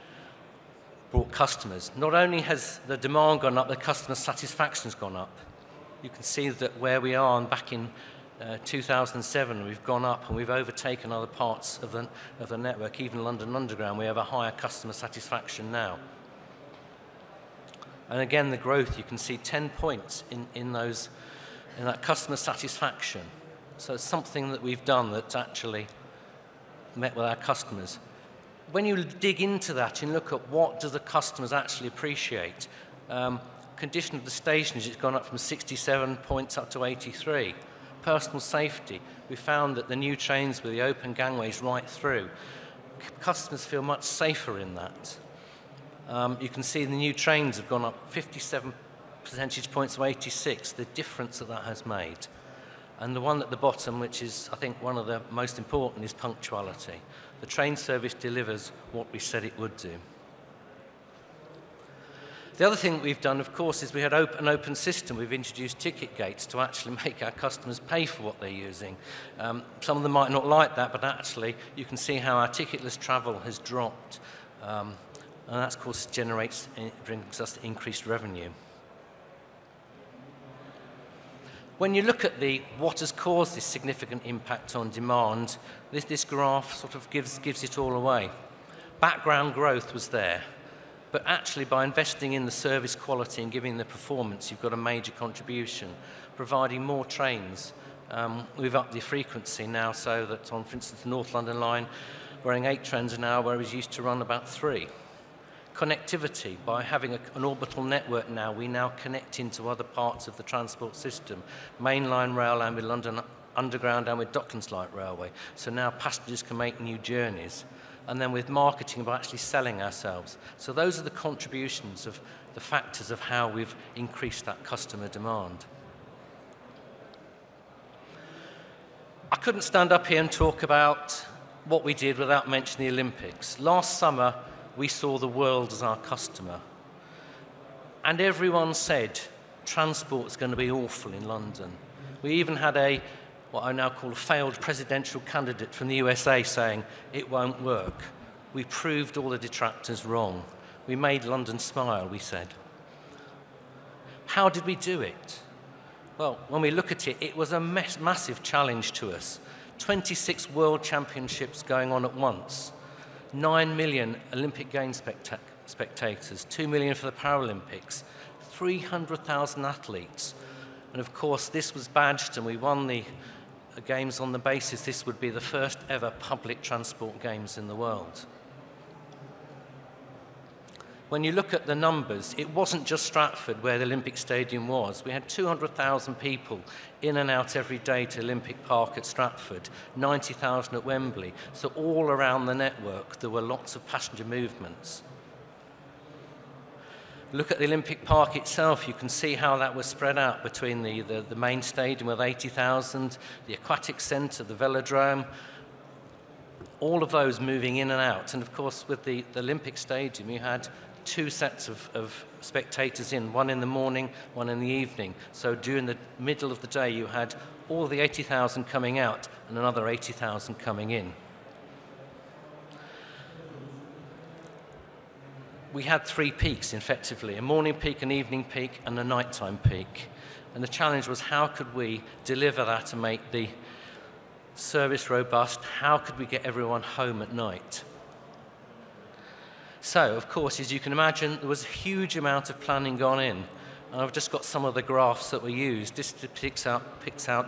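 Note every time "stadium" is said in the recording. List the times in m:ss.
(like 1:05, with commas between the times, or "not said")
3:04, 3:21, 3:29.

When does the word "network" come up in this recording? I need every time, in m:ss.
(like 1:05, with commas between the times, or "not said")
0:12, 1:47, 3:12.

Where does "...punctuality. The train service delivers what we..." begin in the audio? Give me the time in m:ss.
0:56.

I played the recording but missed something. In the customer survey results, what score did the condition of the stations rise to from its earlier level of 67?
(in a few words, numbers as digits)
83.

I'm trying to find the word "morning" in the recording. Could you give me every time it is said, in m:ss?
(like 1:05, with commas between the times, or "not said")
3:33, 3:47.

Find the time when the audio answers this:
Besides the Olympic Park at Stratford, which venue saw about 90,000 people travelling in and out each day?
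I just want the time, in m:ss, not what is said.
3:10.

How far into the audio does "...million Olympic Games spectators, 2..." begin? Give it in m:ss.
2:43.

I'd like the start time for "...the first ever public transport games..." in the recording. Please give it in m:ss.
2:55.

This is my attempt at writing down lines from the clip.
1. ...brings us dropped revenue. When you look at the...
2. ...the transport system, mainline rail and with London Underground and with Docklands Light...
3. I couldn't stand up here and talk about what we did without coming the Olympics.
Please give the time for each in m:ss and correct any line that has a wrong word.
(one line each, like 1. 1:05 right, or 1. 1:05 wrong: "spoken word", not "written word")
1. 1:17 wrong: "increased", not "dropped"
2. 1:50 right
3. 2:09 wrong: "mentioning", not "coming".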